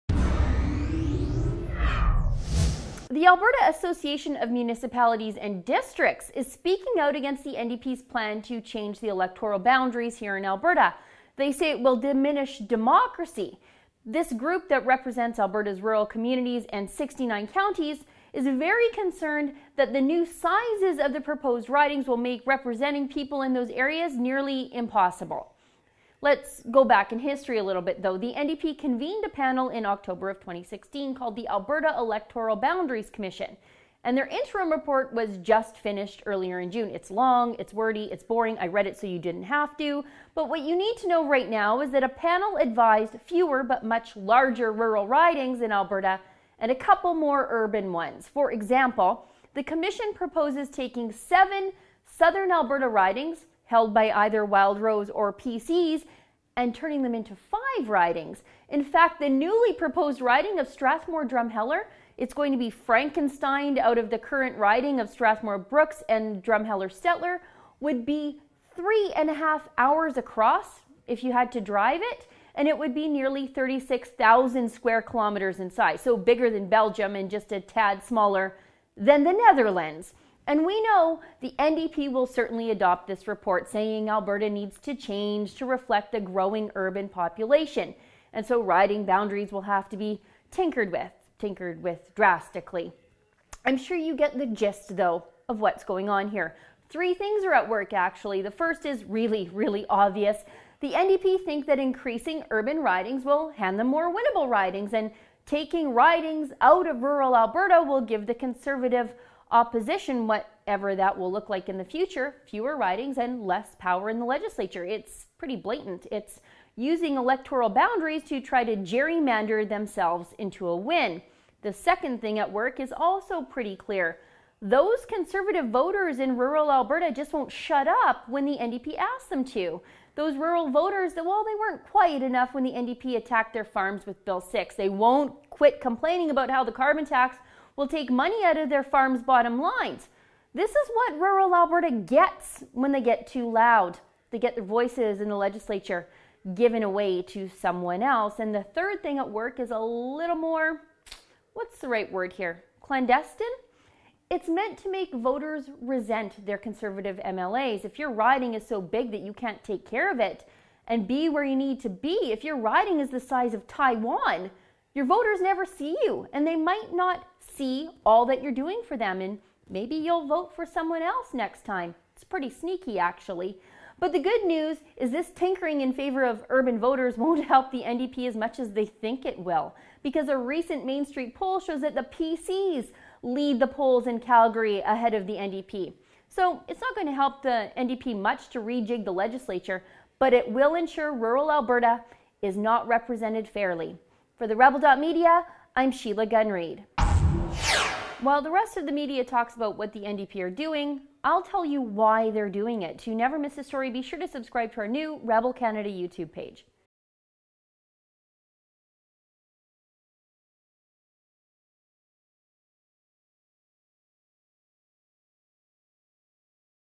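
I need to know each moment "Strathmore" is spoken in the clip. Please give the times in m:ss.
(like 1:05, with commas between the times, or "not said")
1:00, 1:05.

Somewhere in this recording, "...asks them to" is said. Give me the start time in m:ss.
2:08.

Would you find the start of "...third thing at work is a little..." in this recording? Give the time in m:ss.
2:28.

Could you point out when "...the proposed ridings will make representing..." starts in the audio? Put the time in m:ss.
0:21.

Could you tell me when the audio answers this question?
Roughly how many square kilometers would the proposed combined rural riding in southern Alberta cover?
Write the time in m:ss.
1:13.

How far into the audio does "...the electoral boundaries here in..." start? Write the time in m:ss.
0:09.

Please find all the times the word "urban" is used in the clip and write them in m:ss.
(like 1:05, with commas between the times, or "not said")
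0:47, 1:26, 1:42, 2:56.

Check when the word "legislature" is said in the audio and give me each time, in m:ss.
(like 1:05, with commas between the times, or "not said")
1:54, 2:25, 3:09.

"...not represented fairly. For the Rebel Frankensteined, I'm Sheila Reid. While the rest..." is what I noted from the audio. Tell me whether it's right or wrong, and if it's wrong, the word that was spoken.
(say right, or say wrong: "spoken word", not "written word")
wrong: "Media", not "Frankensteined".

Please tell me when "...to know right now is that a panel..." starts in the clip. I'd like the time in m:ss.
0:40.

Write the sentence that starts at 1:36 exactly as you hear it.
Three things are at work, actually.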